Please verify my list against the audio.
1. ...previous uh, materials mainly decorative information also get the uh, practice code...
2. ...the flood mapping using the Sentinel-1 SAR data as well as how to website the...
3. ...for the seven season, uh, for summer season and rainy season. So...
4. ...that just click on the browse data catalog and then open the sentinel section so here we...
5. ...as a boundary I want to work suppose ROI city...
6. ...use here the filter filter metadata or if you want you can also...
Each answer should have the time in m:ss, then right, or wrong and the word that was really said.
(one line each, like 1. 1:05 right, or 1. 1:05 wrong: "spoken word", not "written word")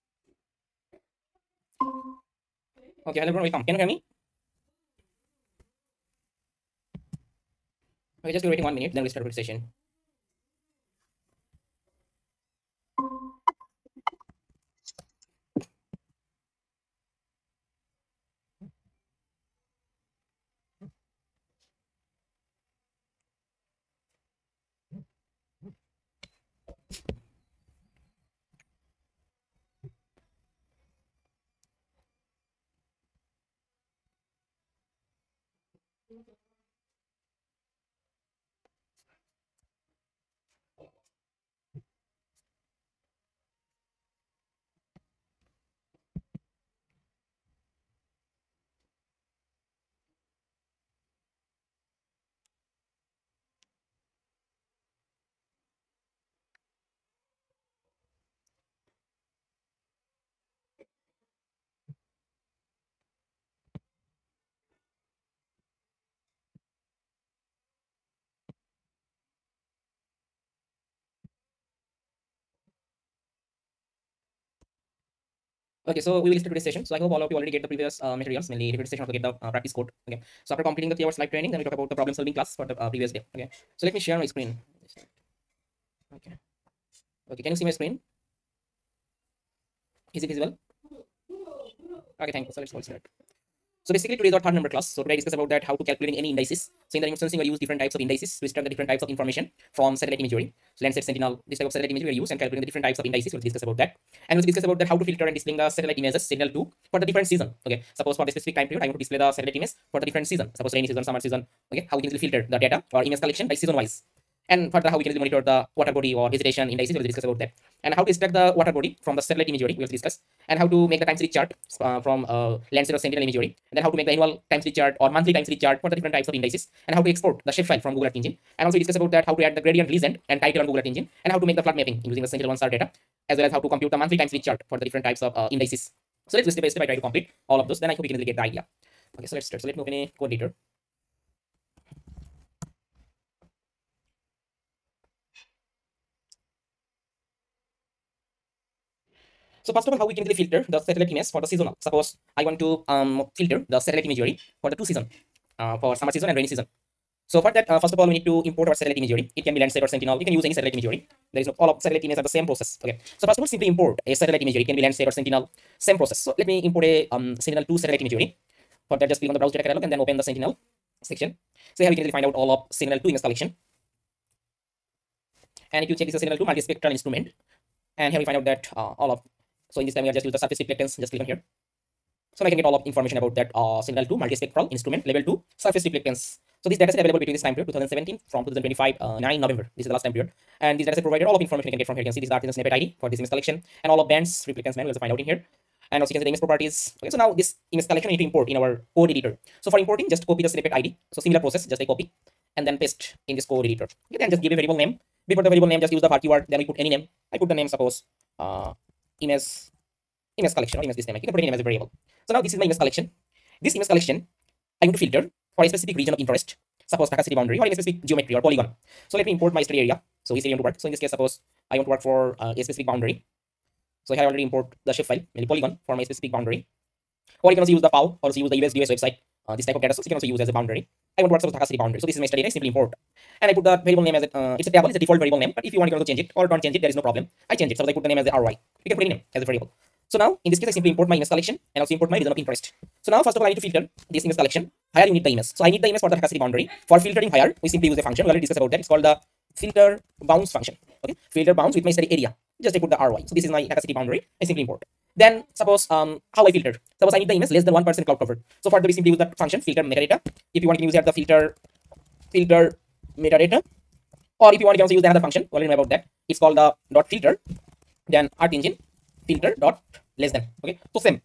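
1. 1:17 wrong: "session", not "information"
2. 2:11 wrong: "compute", not "website"
3. 2:34 wrong: "two", not "seven"
4. 2:49 right
5. 3:50 wrong: "Dhaka", not "ROI"
6. 4:20 right.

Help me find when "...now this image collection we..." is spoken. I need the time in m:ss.
3:17.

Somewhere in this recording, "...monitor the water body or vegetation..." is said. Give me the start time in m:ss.
1:55.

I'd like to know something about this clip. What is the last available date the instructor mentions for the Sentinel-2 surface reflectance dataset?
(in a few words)
9 November 2025.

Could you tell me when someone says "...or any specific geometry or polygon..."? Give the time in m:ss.
3:37.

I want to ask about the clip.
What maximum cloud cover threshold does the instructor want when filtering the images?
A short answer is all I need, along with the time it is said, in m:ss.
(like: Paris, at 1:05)
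less than 1 percent, at 4:17.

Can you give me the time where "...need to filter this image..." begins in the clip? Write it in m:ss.
4:03.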